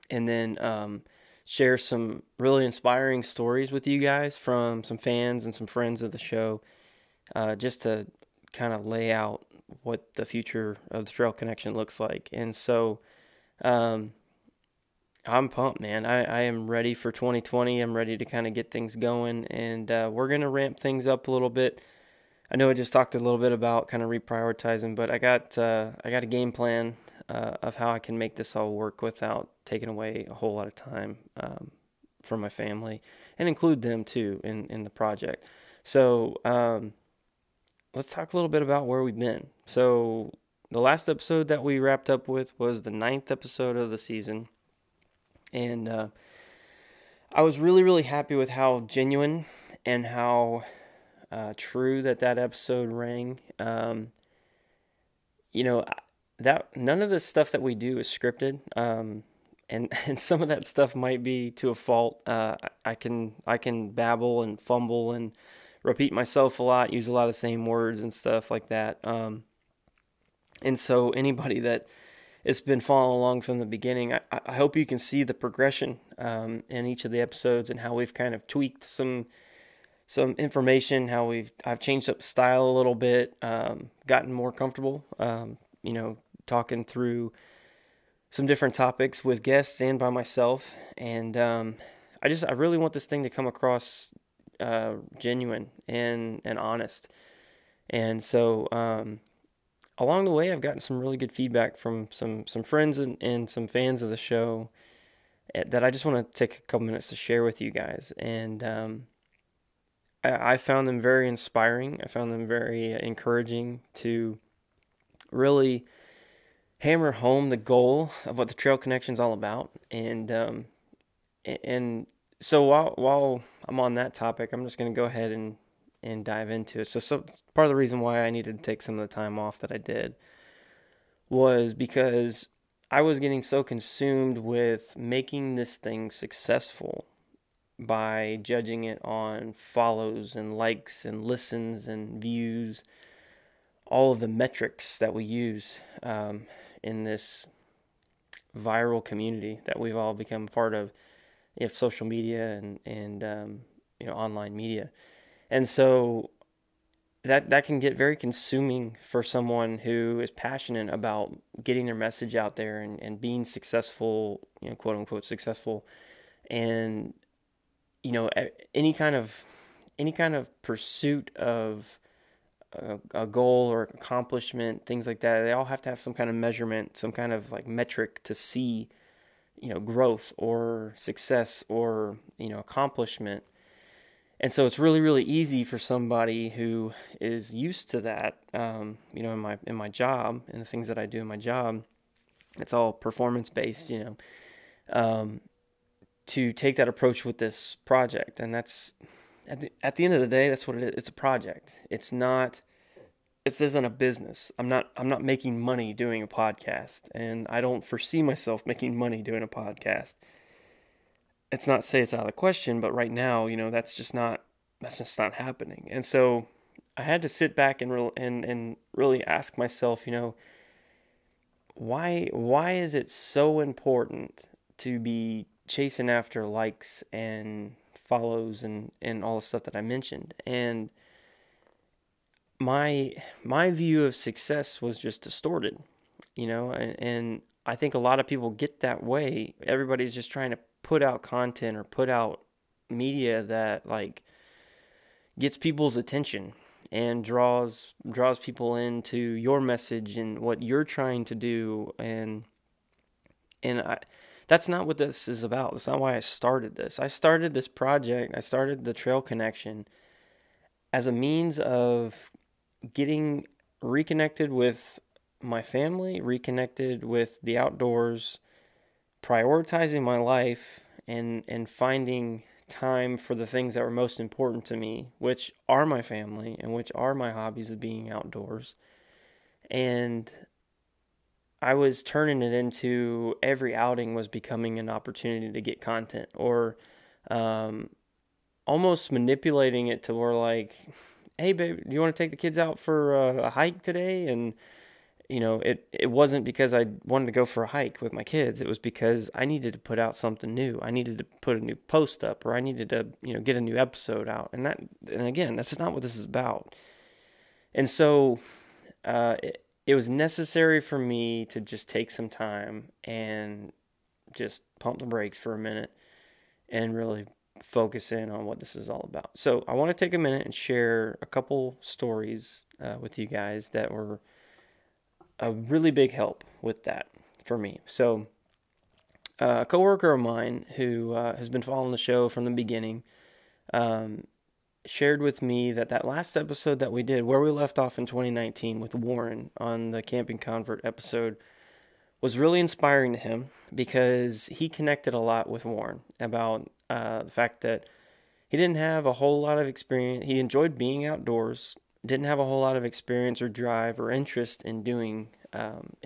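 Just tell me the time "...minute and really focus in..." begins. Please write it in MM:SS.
05:15.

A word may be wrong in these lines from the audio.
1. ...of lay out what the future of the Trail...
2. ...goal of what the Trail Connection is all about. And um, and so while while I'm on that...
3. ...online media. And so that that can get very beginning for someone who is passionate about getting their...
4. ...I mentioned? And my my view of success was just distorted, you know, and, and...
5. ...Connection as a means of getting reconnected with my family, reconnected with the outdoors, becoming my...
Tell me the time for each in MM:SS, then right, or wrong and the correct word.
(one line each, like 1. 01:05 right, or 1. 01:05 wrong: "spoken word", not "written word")
1. 00:08 right
2. 01:57 right
3. 02:34 wrong: "consuming", not "beginning"
4. 03:49 right
5. 04:19 wrong: "prioritizing", not "becoming".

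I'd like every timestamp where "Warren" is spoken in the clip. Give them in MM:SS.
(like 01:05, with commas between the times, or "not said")
05:38, 05:45.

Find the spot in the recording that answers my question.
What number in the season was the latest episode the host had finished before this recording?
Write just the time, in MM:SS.
00:42.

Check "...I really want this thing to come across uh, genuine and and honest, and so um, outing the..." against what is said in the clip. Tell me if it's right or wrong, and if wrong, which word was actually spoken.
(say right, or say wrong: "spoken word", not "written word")
wrong: "along", not "outing".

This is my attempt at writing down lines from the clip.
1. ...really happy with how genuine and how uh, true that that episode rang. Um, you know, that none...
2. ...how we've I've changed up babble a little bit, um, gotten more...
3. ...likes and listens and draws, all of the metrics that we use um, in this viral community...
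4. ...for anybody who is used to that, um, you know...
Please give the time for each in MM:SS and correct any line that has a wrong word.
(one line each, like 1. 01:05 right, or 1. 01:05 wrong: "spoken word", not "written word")
1. 00:47 right
2. 01:21 wrong: "style", not "babble"
3. 02:20 wrong: "views", not "draws"
4. 03:05 wrong: "somebody", not "anybody".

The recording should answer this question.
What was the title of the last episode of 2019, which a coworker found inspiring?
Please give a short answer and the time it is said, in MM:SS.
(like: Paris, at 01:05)
Camping Convert, at 05:40.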